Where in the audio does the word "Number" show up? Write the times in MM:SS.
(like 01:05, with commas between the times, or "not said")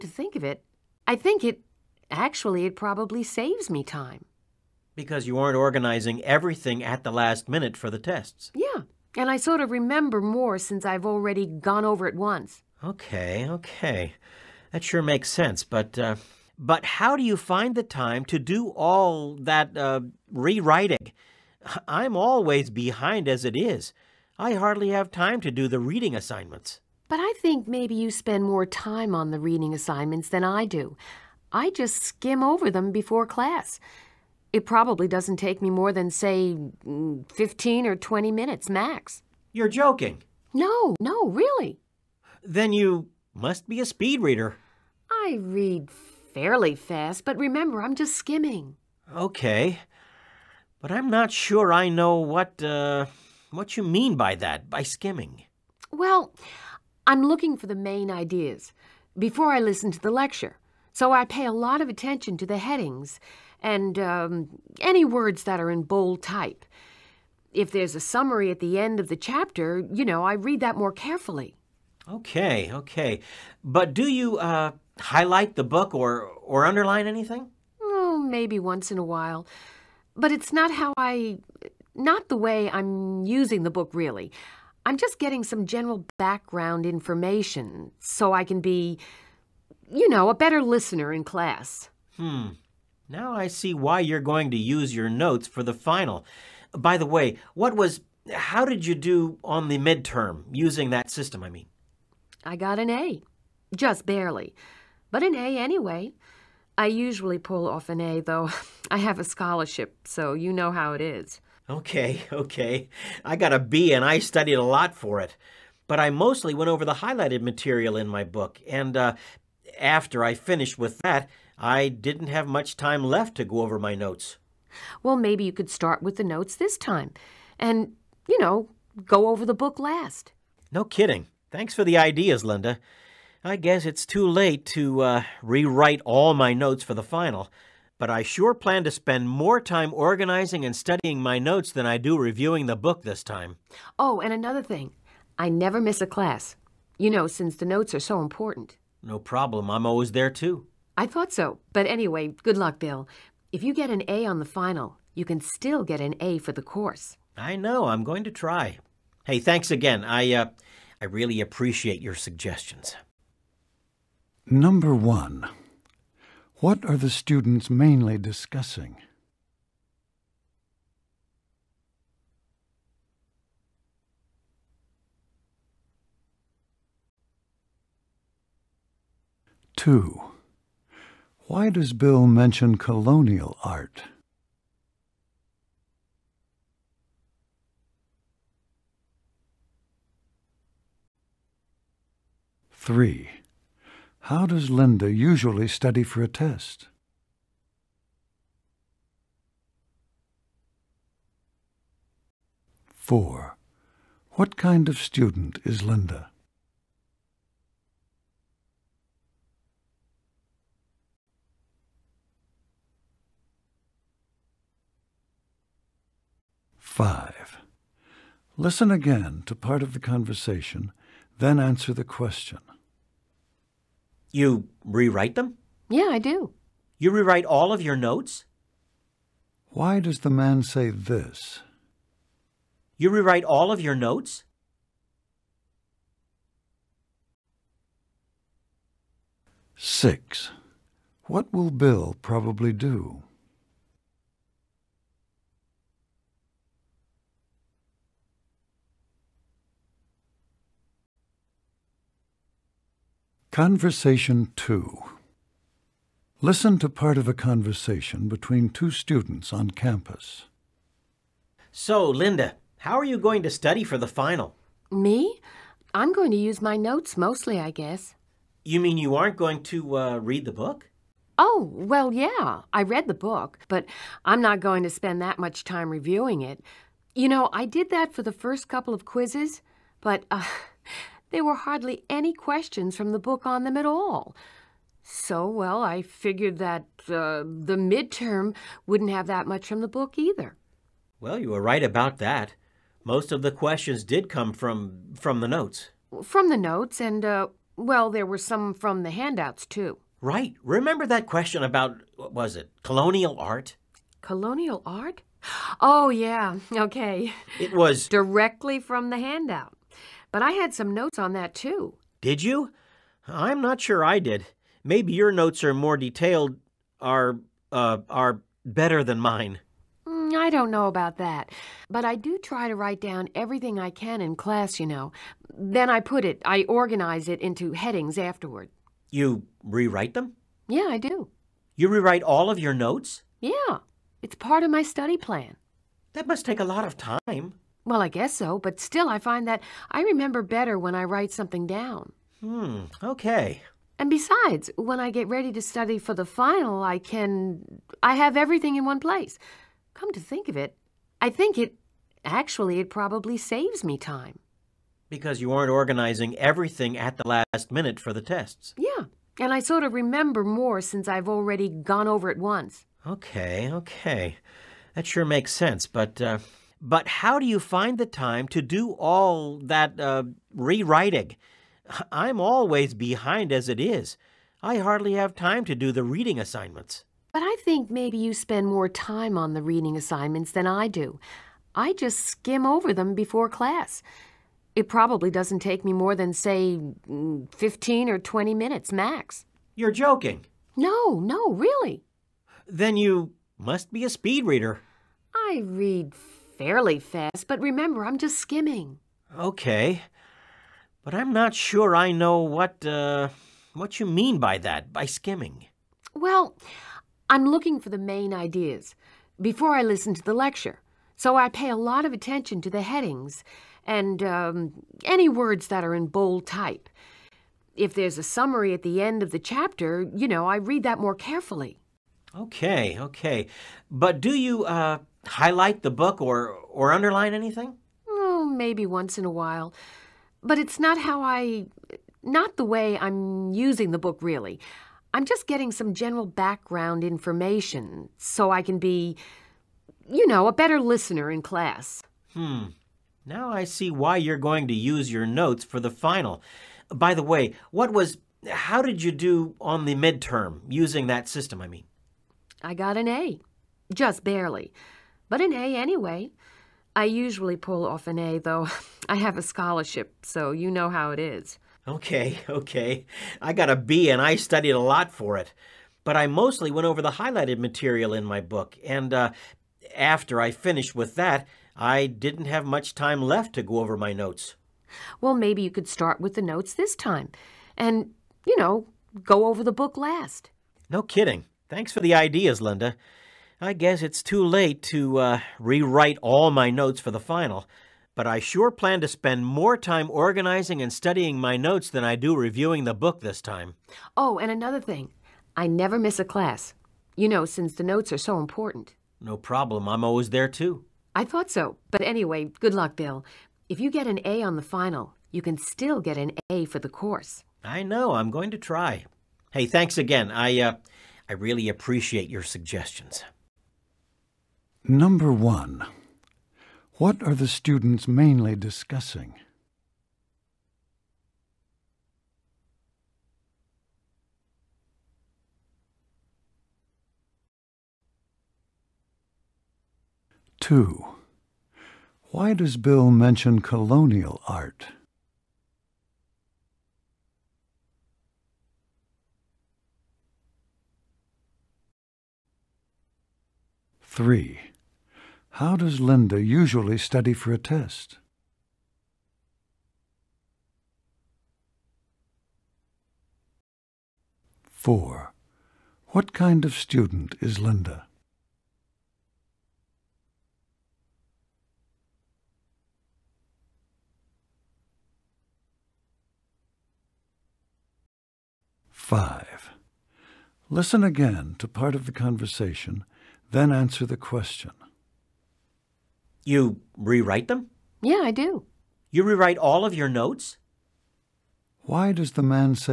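02:44, 08:34.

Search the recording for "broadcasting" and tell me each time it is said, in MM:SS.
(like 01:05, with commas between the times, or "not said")
not said.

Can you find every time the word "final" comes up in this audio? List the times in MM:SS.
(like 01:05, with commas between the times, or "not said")
01:35, 02:17, 02:34, 04:24, 05:46, 07:25, 08:07, 08:24.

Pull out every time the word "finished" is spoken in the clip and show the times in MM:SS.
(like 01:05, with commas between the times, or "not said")
02:00, 07:50.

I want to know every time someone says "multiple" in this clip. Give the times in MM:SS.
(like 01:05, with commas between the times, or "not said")
not said.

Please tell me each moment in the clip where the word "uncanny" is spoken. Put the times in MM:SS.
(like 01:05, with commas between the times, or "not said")
not said.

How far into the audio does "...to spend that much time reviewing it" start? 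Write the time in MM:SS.
04:34.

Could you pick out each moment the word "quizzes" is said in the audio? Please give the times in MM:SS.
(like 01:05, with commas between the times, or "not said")
04:39.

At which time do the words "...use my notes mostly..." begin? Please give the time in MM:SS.
04:26.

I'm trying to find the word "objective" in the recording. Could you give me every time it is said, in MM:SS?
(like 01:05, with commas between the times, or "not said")
not said.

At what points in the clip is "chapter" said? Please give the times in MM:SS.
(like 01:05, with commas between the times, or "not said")
01:09, 06:59.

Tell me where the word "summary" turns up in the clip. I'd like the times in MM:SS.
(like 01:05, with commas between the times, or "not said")
01:08, 06:58.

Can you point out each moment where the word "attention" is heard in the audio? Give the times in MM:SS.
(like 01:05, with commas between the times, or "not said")
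01:01, 06:52.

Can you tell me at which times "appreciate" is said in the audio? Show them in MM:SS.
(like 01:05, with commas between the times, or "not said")
02:41, 08:31.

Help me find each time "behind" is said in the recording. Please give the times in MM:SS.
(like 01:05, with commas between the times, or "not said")
00:22, 06:12.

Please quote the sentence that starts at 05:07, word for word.
It was directly from the handout.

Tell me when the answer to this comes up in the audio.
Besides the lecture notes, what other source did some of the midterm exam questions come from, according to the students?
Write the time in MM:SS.
04:59.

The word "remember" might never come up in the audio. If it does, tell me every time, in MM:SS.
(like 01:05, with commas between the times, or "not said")
00:09, 00:47, 05:00, 05:40, 05:59, 06:37.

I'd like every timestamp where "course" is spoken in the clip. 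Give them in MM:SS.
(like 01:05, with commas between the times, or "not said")
02:36, 08:26.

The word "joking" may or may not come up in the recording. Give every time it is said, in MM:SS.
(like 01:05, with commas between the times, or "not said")
00:39, 06:29.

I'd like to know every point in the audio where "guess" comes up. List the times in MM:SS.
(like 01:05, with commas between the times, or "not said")
02:13, 04:27, 05:38, 08:03.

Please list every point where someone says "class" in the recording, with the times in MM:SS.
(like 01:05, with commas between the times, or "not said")
00:33, 01:31, 02:26, 05:24, 06:23, 07:21, 08:16.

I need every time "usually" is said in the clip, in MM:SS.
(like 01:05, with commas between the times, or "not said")
01:46, 03:15, 07:37, 09:06.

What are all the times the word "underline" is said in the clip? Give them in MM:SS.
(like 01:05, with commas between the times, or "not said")
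01:16, 07:06.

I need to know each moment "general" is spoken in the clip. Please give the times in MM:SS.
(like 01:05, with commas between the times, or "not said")
01:25, 07:15.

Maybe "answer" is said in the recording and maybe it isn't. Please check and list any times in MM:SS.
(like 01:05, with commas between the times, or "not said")
03:41, 09:33.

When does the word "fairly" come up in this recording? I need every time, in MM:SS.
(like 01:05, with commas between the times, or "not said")
00:45, 06:36.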